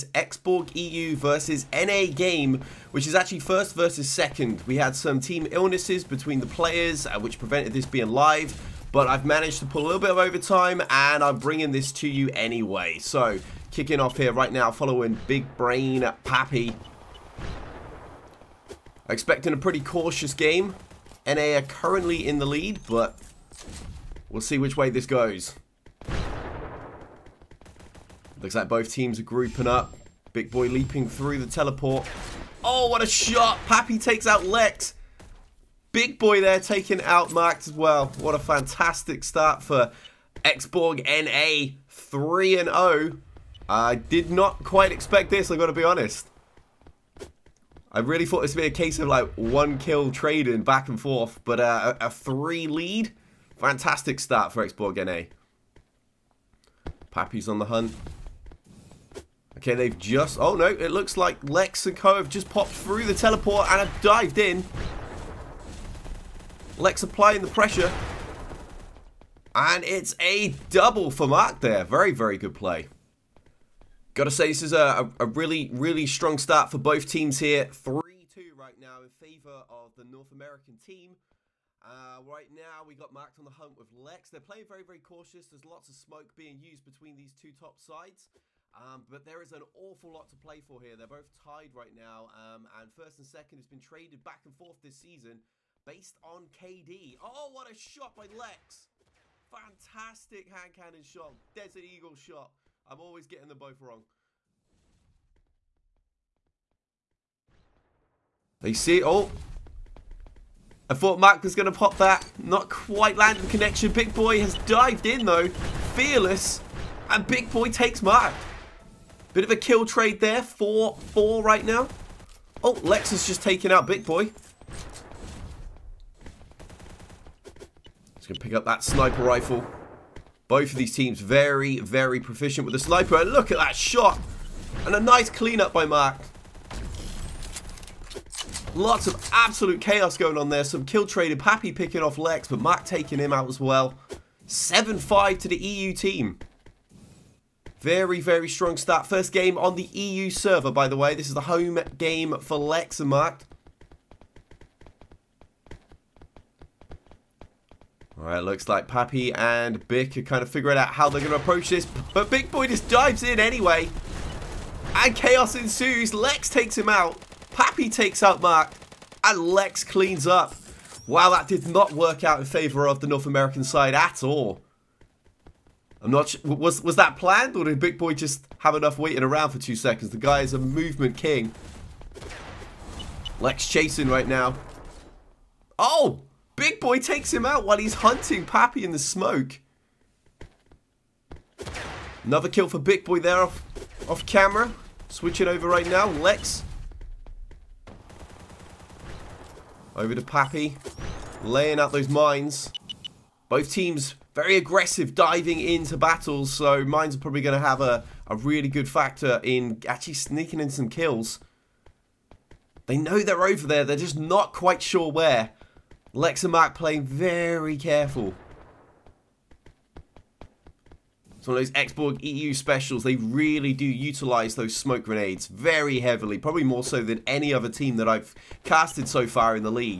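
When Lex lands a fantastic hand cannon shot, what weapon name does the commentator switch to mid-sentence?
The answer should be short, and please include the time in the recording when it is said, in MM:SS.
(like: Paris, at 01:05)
Desert Eagle, at 01:41.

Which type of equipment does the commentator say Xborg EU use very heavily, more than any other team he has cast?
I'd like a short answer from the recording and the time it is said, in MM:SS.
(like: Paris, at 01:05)
Smoke grenades, at 03:44.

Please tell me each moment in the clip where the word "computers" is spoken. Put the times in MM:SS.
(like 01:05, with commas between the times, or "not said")
not said.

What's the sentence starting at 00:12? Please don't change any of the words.
So kicking off here right now following Big Brain Pappy.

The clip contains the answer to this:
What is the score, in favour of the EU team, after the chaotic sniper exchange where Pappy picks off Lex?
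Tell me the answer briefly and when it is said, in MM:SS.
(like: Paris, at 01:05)
7-5, at 02:24.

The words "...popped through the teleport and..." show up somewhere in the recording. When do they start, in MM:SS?
01:02.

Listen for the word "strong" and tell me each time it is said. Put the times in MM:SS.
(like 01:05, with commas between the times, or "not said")
01:16, 02:28.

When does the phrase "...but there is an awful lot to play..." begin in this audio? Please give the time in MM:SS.
01:29.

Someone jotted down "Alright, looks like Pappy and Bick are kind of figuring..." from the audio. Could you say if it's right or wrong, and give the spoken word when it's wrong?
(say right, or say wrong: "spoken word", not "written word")
right.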